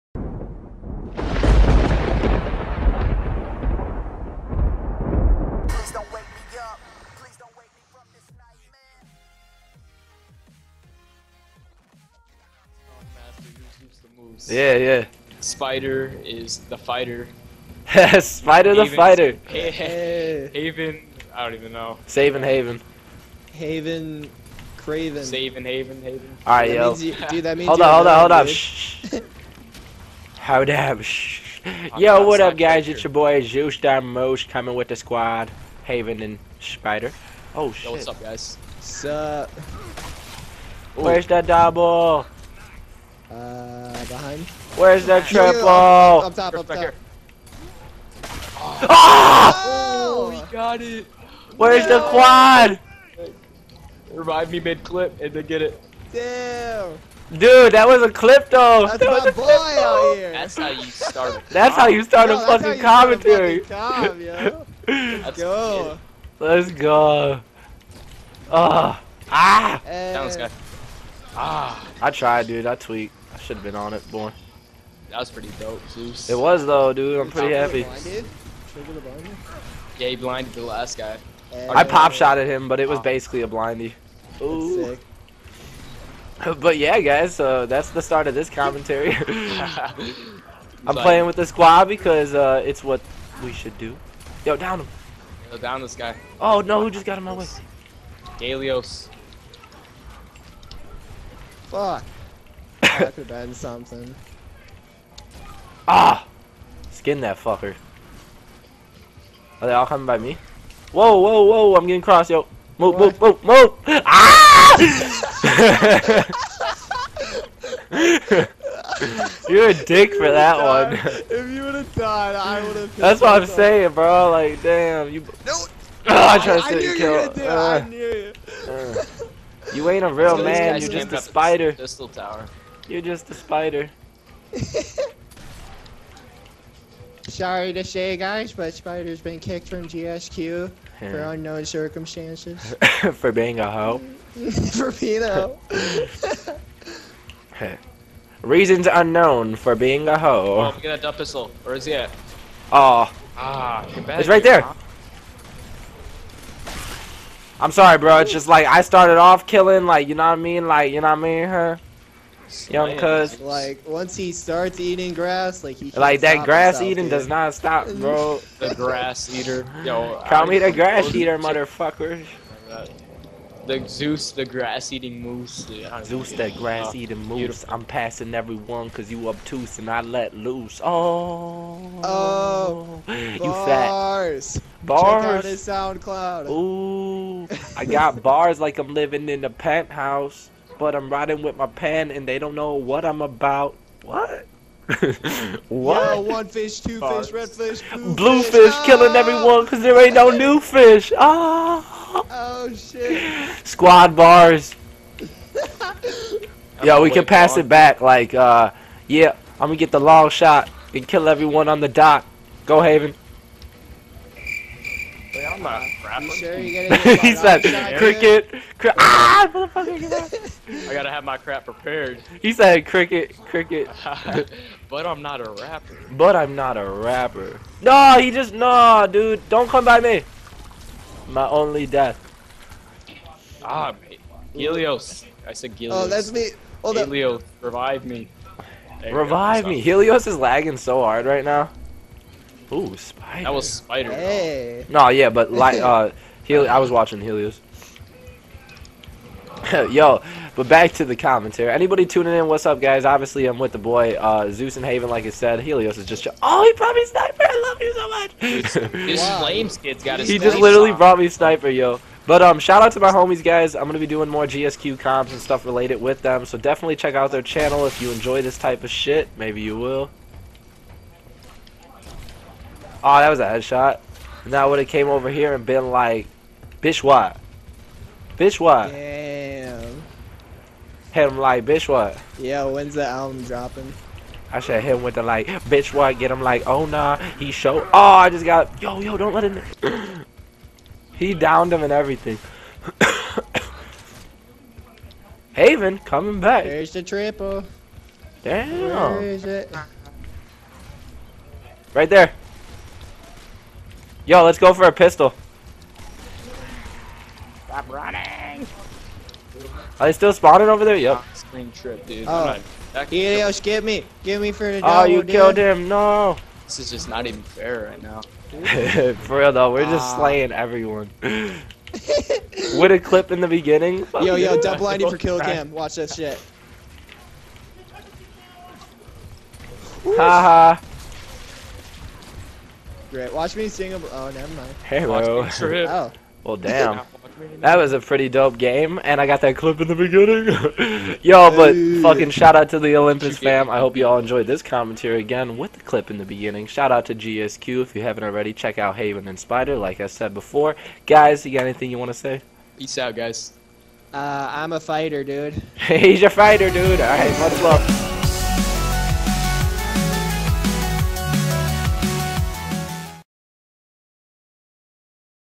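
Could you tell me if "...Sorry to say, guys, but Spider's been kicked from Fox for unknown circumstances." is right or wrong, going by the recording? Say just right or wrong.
wrong.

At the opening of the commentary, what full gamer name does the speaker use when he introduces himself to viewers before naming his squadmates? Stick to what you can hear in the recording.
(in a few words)
Zeus Mosh.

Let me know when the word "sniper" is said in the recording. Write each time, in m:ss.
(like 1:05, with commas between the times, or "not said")
4:17, 4:21.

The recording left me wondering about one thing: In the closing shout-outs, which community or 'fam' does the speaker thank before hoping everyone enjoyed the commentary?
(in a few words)
Olympus.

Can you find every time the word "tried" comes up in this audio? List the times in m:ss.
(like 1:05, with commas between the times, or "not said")
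1:12, 2:06.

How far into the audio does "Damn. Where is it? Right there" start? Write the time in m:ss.
4:58.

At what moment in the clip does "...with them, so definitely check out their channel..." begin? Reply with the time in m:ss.
4:26.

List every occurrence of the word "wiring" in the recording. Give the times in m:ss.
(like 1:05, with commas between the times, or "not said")
not said.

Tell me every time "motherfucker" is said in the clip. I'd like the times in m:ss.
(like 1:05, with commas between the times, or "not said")
2:51, 3:39.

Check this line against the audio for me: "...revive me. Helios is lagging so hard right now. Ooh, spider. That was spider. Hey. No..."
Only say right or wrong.
right.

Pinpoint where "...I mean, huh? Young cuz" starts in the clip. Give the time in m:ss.
2:41.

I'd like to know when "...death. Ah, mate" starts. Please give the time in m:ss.
3:51.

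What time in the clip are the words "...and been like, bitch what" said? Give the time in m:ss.
4:35.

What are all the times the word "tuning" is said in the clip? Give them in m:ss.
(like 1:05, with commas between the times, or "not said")
4:12.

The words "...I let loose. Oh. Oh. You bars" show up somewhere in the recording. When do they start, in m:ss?
2:59.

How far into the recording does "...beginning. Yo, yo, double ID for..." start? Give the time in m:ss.
5:23.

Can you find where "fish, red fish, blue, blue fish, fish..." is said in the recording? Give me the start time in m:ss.
3:17.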